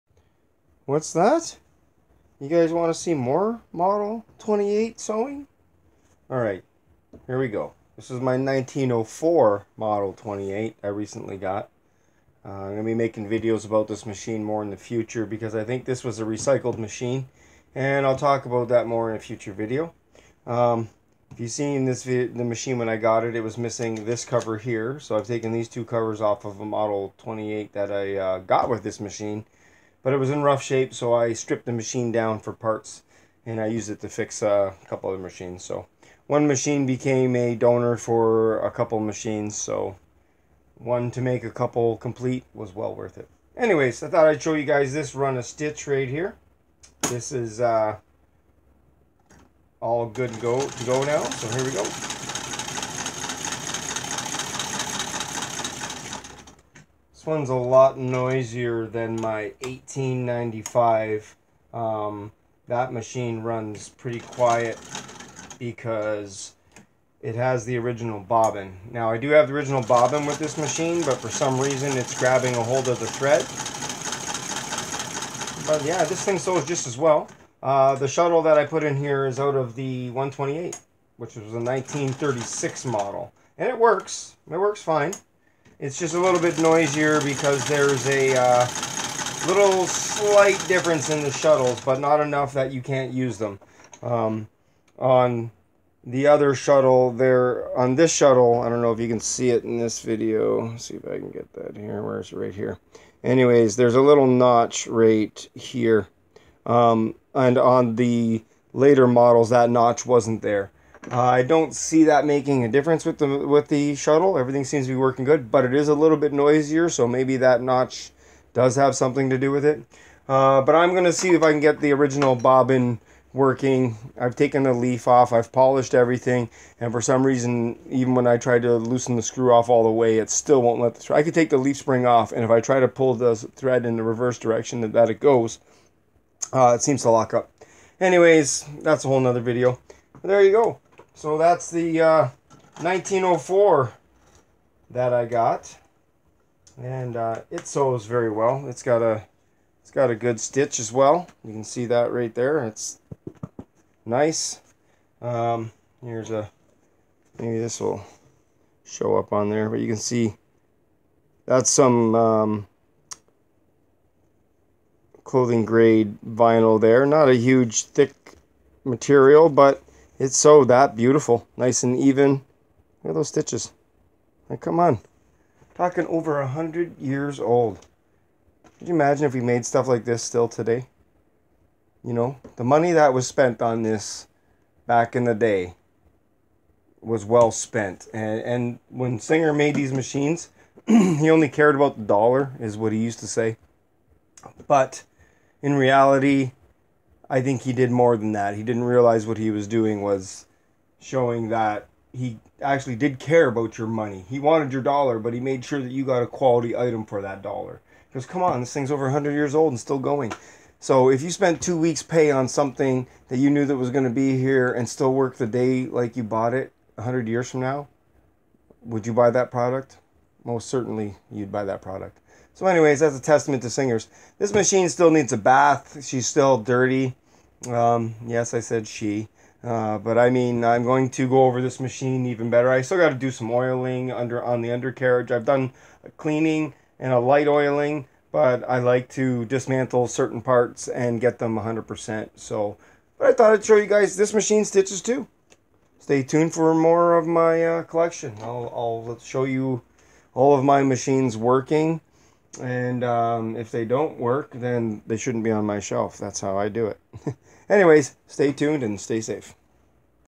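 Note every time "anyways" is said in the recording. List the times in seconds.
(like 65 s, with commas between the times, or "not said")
43 s, 103 s, 137 s, 222 s, 257 s.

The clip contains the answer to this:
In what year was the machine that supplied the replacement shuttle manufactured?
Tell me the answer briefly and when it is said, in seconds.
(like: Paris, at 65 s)
1936, at 81 s.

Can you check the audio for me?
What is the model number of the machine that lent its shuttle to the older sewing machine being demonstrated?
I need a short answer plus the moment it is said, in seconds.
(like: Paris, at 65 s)
128, at 80 s.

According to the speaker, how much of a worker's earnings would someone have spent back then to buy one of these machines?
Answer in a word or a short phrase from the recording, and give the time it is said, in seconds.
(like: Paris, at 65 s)
two weeks' pay, at 211 s.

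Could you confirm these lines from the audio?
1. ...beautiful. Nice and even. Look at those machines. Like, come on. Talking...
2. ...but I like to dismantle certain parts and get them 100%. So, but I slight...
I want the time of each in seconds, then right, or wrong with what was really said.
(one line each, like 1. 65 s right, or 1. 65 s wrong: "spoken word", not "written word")
1. 170 s wrong: "stitches", not "machines"
2. 238 s wrong: "thought", not "slight".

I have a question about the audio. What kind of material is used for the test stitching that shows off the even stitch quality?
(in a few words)
clothing grade vinyl.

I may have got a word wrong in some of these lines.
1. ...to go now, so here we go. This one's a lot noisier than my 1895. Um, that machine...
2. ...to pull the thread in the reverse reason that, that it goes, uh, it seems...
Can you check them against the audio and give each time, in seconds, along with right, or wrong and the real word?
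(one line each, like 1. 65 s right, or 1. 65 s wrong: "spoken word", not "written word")
1. 50 s right
2. 132 s wrong: "direction", not "reason".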